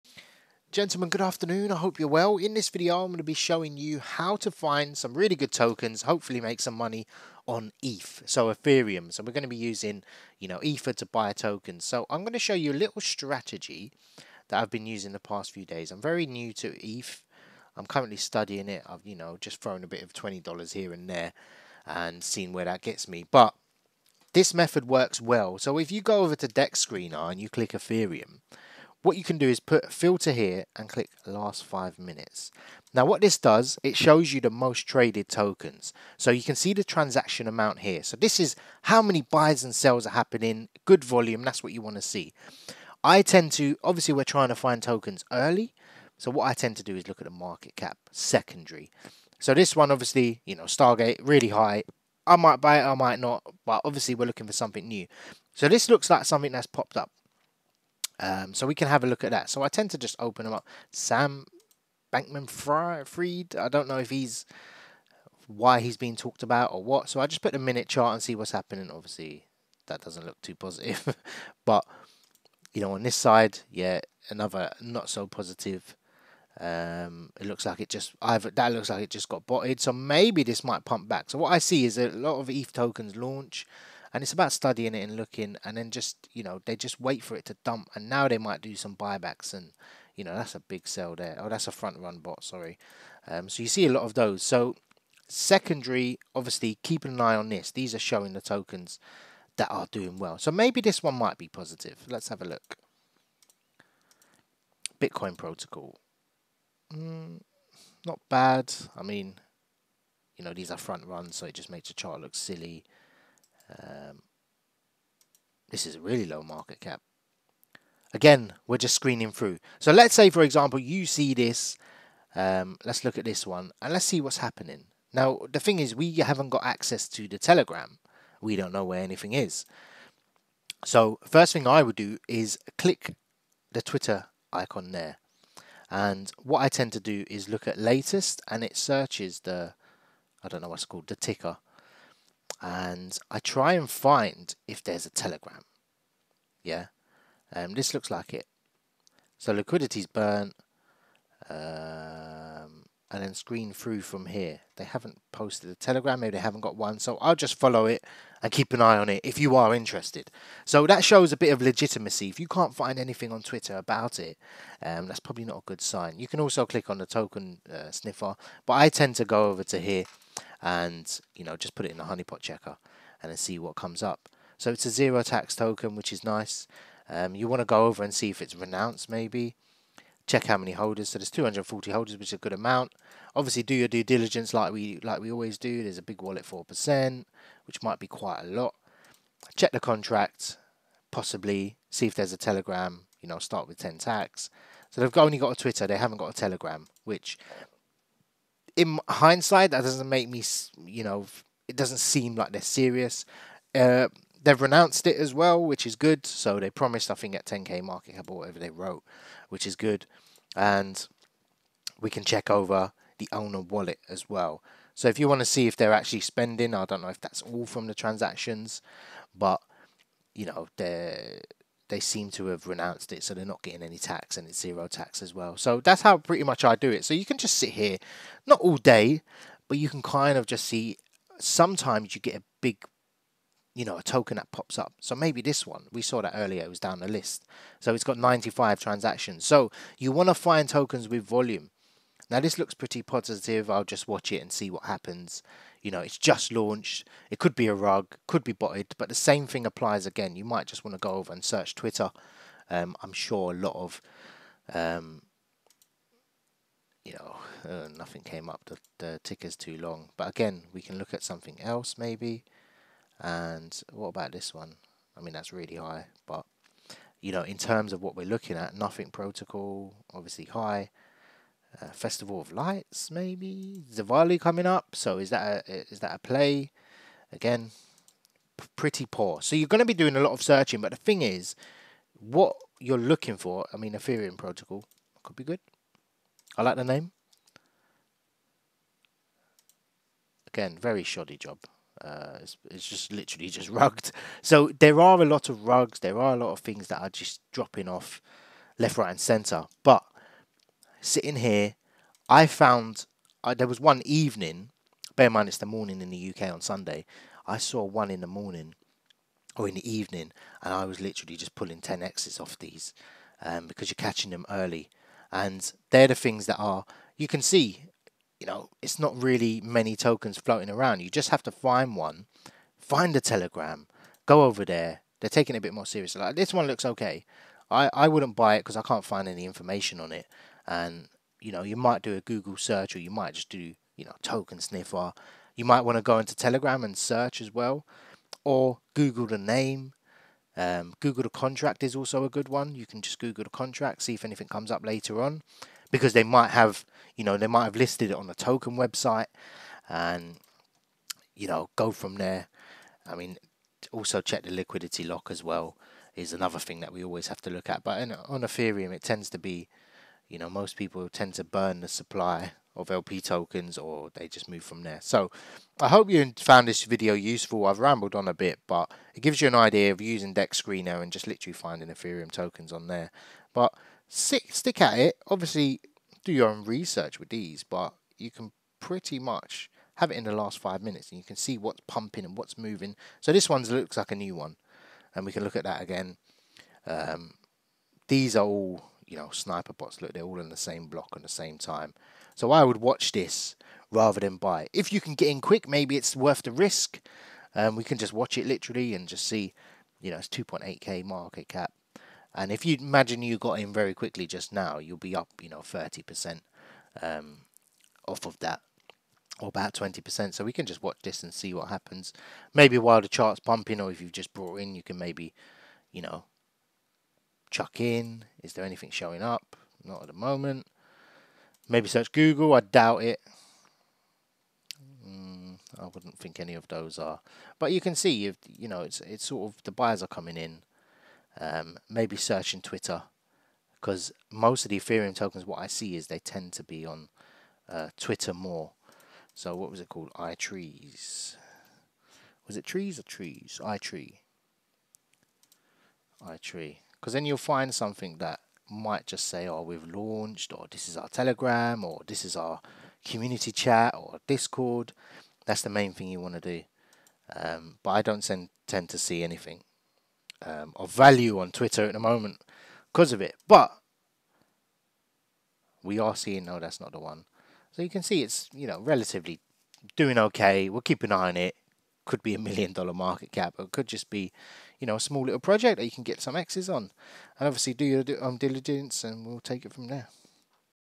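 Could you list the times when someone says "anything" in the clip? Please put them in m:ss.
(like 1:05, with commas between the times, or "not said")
2:09, 2:42, 5:44, 6:58, 7:39.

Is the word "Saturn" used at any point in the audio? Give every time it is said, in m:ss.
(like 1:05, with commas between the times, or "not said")
not said.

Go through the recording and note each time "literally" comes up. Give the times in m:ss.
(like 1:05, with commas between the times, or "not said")
4:53, 5:11, 6:11, 6:38.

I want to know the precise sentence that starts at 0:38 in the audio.
So this is how many buys and sells are happening, good volume, that's what you want to see.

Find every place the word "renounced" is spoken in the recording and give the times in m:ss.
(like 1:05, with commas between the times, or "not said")
2:58, 3:24, 3:42.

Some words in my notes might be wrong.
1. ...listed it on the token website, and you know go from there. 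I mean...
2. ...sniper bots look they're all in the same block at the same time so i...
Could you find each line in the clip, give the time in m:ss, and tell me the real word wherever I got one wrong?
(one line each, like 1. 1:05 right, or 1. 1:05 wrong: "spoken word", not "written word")
1. 5:47 right
2. 6:29 right.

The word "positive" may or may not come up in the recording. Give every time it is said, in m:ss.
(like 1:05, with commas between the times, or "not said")
1:10, 1:15, 1:41, 4:03.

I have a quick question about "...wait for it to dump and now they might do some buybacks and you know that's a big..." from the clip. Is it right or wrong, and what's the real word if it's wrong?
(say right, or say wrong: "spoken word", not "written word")
right.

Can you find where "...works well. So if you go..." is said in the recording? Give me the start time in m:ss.
0:24.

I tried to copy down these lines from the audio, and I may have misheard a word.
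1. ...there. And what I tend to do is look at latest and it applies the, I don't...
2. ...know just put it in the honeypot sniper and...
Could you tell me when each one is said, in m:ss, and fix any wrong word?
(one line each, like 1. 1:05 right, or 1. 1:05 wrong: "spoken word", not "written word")
1. 2:14 wrong: "searches", not "applies"
2. 2:51 wrong: "checker", not "sniper".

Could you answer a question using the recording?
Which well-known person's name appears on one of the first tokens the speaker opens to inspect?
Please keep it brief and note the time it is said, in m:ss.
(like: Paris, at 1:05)
Sam Bankman Fried, at 1:00.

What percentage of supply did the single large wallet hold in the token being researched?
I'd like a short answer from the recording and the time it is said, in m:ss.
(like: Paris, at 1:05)
4%, at 3:06.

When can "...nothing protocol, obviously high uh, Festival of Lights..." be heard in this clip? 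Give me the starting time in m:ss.
4:28.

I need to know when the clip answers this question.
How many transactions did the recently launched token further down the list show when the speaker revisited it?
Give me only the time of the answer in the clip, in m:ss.
3:58.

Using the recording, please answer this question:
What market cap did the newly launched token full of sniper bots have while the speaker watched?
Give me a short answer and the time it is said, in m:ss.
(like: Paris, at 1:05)
2.8k, at 6:40.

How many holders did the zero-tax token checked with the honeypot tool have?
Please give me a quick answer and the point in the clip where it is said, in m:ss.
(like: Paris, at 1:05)
240, at 3:01.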